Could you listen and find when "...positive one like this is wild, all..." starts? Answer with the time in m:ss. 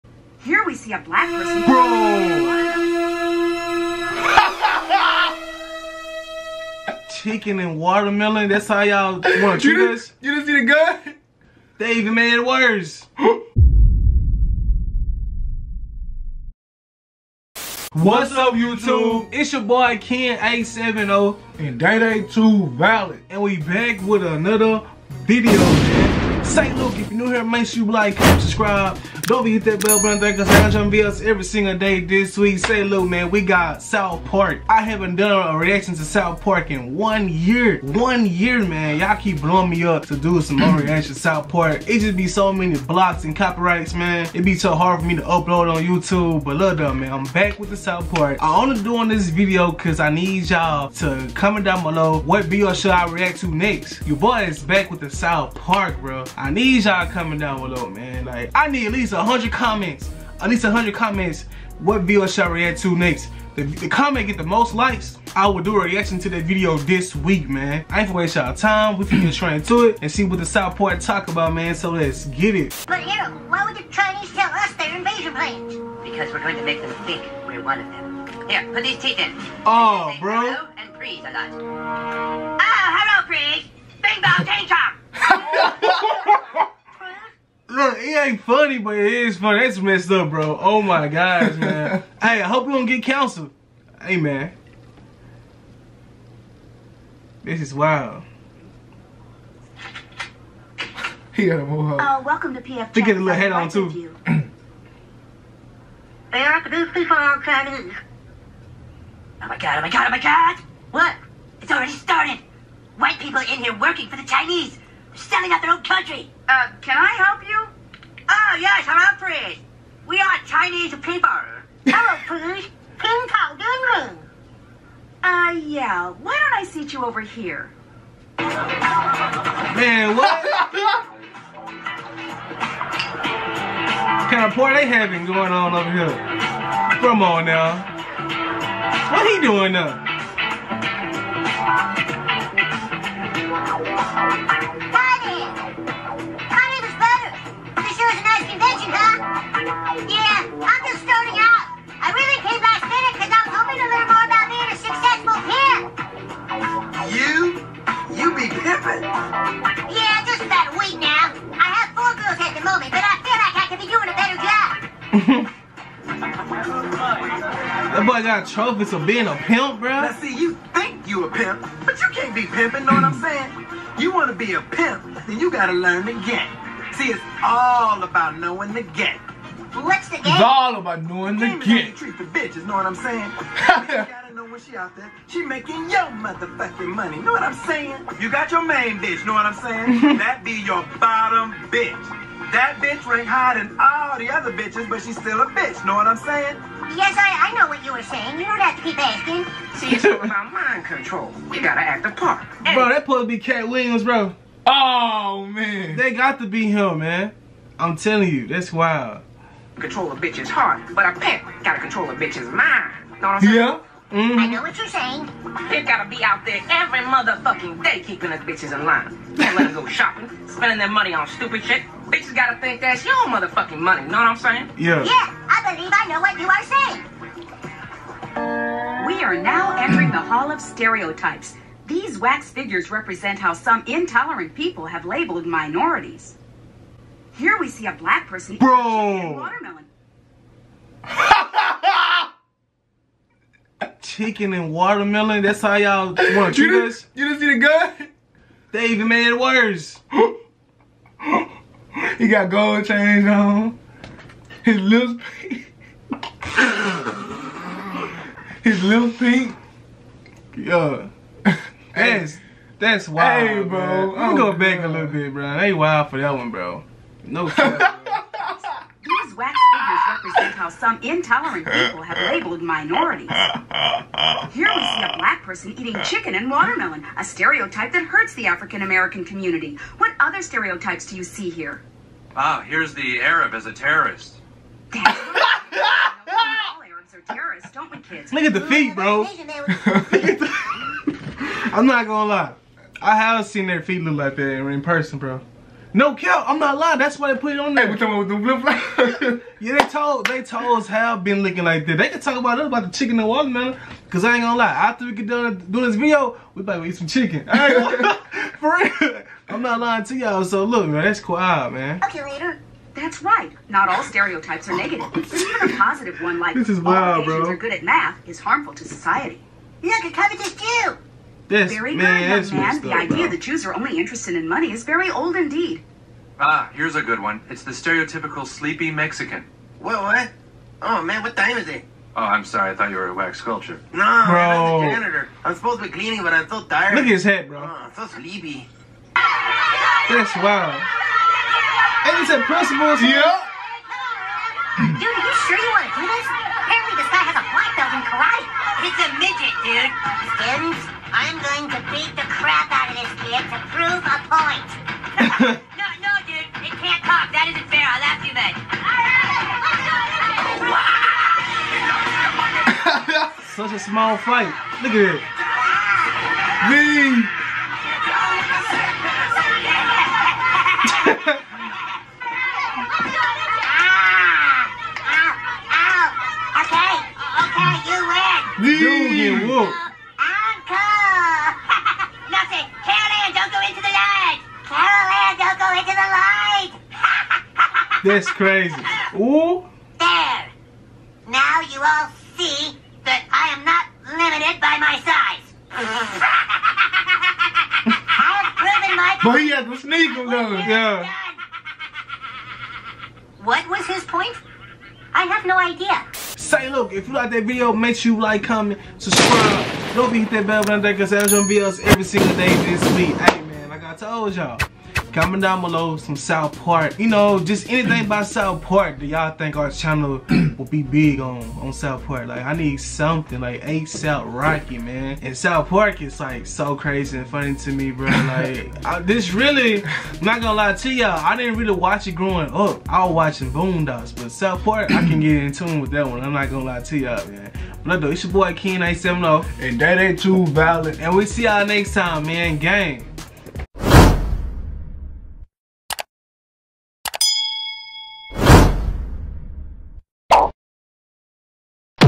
5:15.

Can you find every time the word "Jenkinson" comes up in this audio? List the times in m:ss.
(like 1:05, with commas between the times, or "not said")
not said.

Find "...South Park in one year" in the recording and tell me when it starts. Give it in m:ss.
0:36.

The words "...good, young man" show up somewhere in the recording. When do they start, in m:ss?
5:21.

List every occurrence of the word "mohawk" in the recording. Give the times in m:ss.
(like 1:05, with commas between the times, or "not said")
1:41.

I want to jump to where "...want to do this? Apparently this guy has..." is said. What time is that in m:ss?
5:45.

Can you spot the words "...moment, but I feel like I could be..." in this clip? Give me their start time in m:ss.
2:42.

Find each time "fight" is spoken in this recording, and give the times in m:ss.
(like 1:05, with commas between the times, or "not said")
6:04.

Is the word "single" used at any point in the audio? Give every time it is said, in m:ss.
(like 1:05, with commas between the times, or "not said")
0:31, 6:52.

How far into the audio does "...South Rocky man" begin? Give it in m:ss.
7:03.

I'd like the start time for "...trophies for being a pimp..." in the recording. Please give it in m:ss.
2:48.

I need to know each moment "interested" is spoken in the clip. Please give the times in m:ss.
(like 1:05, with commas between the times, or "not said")
5:23.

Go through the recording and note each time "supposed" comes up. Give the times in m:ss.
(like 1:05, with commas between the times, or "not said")
3:23, 5:35.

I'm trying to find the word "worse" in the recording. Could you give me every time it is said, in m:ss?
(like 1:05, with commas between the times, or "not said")
0:12, 4:09.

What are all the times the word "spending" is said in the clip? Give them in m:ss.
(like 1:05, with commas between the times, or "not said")
3:40.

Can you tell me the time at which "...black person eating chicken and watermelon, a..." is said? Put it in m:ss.
4:35.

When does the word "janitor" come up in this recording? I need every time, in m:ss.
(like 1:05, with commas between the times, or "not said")
5:34.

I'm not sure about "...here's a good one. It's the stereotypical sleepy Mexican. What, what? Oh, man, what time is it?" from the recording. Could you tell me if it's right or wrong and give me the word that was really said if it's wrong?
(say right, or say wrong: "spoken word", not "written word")
right.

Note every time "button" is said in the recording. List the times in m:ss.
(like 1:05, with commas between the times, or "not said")
0:30, 6:50.